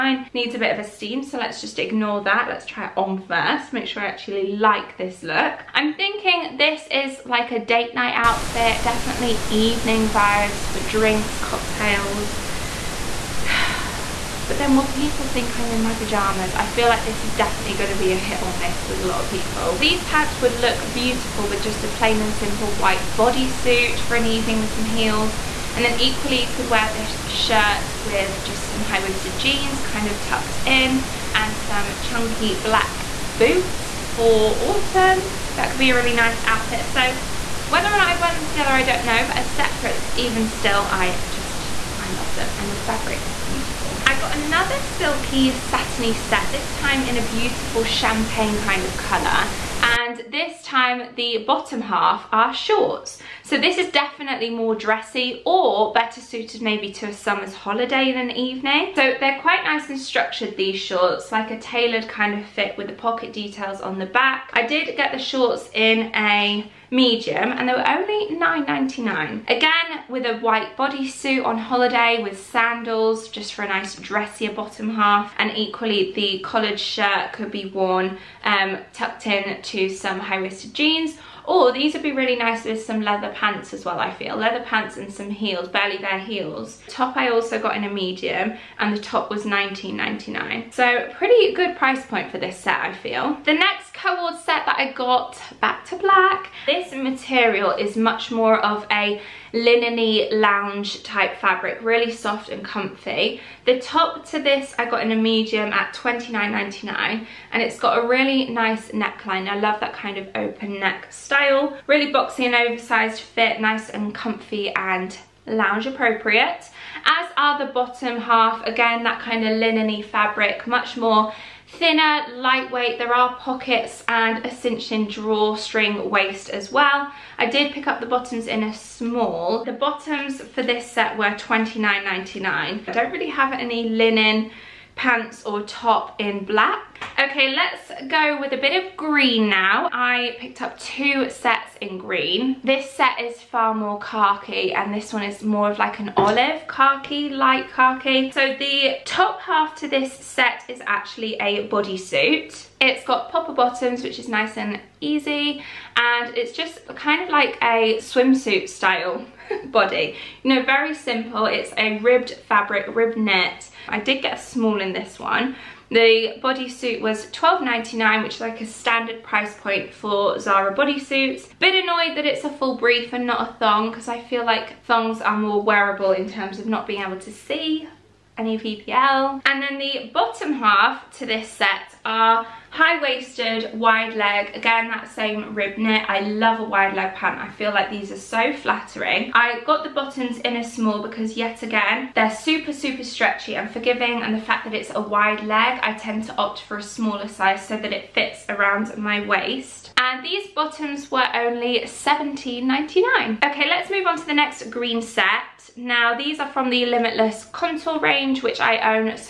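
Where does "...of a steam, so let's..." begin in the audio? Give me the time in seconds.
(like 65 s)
0 s.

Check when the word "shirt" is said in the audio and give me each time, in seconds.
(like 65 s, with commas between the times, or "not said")
27 s, 76 s.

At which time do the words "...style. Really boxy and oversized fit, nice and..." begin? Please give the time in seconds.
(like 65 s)
111 s.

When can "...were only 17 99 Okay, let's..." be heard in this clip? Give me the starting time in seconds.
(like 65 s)
201 s.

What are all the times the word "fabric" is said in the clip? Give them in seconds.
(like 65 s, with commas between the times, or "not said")
42 s, 101 s, 120 s, 162 s.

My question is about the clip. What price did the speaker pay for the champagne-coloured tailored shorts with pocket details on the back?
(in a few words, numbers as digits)
$9.99.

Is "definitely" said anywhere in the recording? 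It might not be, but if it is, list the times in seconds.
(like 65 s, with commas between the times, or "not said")
8 s, 17 s, 53 s.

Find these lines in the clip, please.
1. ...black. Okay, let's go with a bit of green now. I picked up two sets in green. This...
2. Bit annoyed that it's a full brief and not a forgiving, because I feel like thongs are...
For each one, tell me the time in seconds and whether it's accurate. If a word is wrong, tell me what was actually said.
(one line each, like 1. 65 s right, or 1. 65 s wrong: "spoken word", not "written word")
1. 136 s right
2. 171 s wrong: "thong", not "forgiving".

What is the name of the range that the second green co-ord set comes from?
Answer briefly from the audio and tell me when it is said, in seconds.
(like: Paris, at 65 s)
Limitless Contour, at 206 s.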